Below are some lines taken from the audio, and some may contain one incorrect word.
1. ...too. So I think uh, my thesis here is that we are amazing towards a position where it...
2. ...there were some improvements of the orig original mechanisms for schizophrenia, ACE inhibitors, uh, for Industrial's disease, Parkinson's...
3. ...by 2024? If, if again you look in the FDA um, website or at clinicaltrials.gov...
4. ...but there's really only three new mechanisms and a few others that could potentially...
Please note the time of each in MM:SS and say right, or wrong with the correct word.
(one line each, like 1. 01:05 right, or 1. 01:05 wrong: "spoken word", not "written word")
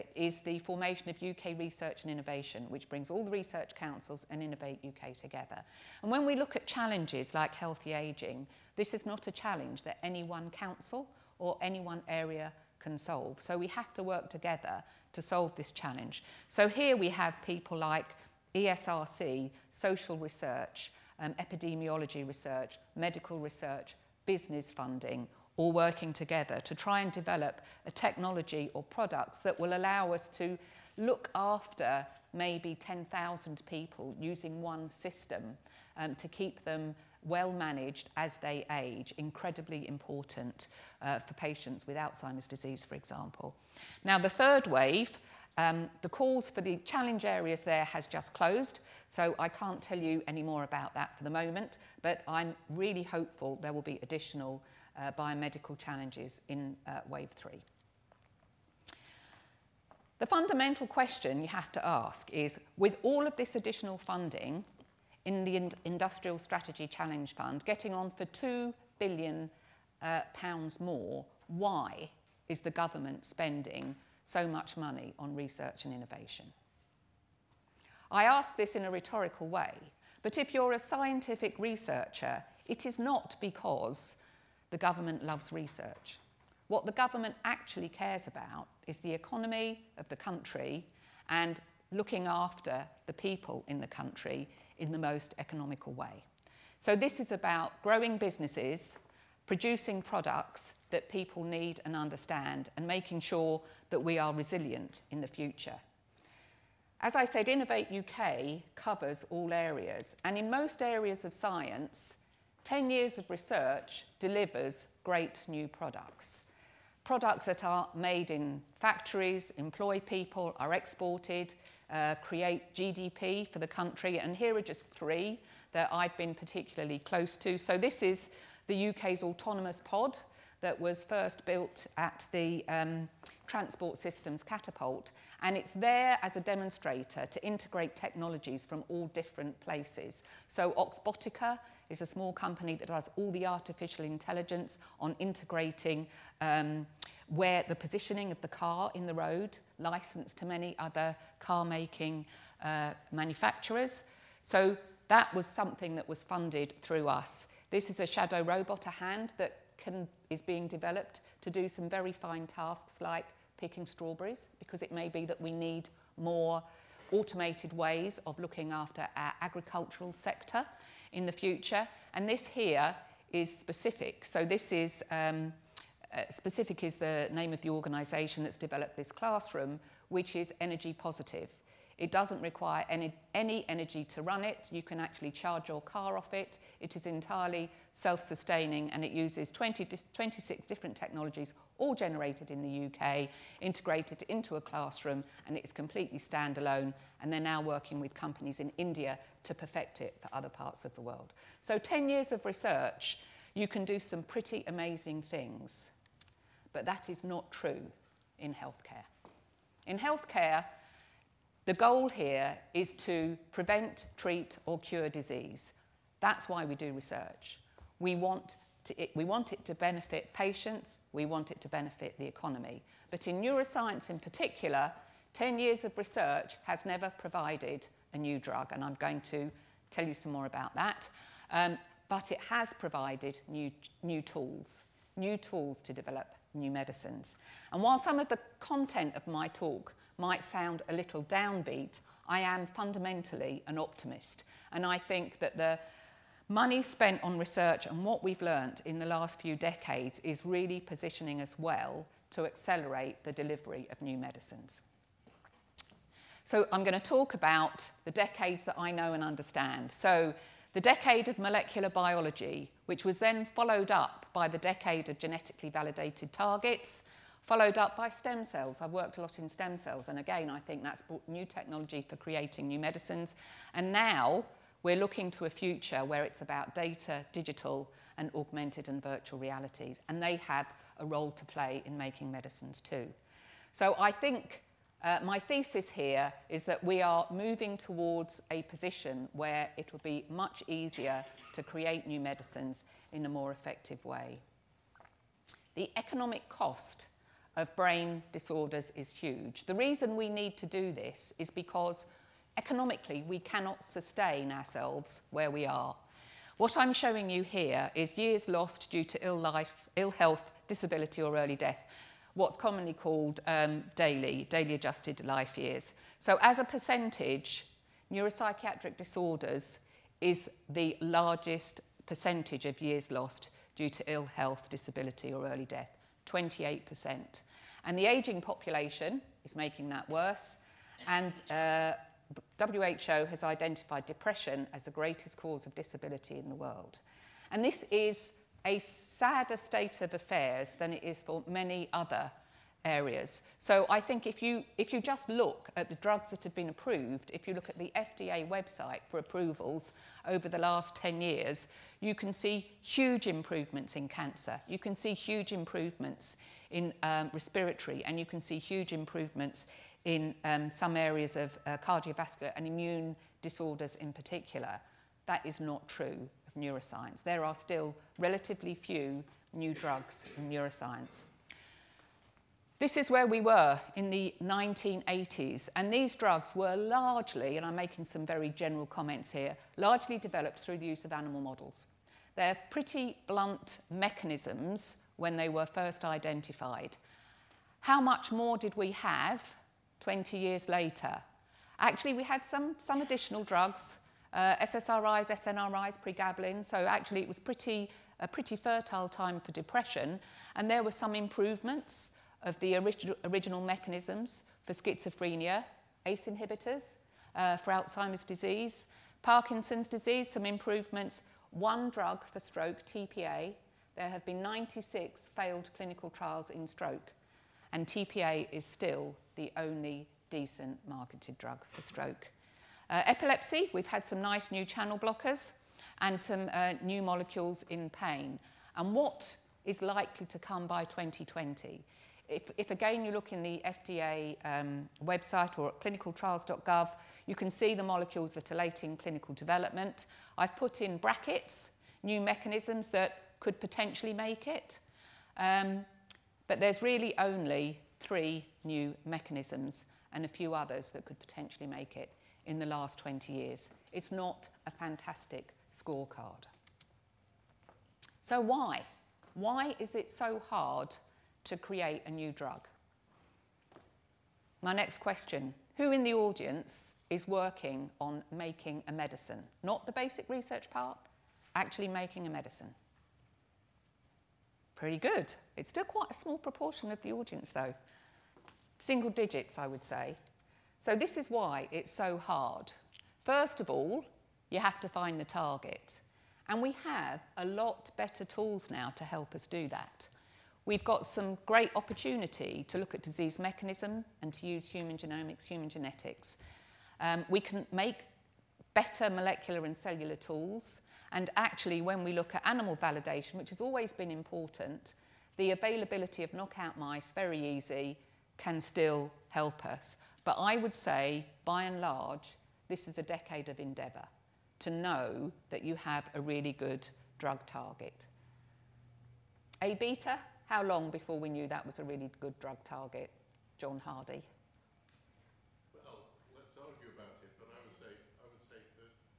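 1. 04:42 wrong: "moving", not "amazing"
2. 06:40 wrong: "Alzheimer", not "Industrial"
3. 07:10 wrong: "2020", not "2024"
4. 07:26 right.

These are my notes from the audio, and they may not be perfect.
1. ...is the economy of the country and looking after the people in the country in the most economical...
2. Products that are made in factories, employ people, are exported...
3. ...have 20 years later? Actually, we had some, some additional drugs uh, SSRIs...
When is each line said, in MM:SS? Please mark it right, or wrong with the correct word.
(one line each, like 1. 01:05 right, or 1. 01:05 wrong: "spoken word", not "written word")
1. 01:28 right
2. 01:57 right
3. 06:28 right.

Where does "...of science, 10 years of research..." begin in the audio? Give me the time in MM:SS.
01:51.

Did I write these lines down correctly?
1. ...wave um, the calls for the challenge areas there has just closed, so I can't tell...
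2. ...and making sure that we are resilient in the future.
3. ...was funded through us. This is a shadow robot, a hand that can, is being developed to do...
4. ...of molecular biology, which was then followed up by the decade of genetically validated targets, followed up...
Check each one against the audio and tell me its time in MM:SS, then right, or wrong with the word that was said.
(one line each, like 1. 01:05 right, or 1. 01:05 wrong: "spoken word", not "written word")
1. 00:44 right
2. 01:42 right
3. 02:36 right
4. 04:21 right.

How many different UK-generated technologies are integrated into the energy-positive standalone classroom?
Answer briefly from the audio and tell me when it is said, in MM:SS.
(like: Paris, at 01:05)
26, at 03:10.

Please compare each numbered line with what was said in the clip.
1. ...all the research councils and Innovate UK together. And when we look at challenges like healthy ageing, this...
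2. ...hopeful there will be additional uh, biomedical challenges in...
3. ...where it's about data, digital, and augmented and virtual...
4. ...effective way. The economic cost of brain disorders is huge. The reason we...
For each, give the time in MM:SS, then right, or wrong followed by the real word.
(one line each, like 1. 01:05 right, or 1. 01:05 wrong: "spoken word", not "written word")
1. 00:03 right
2. 00:53 right
3. 04:36 right
4. 04:53 right.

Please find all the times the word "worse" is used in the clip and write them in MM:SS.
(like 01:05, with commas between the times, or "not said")
05:30.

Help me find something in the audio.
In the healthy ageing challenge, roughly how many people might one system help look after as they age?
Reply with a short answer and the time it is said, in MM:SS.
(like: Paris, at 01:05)
10,000, at 00:32.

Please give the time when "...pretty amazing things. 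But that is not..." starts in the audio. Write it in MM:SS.
03:24.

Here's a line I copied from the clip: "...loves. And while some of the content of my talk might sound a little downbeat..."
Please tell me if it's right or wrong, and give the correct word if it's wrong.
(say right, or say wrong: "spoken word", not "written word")
wrong: "medicines", not "loves".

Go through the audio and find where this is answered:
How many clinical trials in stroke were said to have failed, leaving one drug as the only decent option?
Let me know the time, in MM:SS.
06:54.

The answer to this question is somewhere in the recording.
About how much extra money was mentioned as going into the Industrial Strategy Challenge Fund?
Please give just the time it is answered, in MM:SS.
01:08.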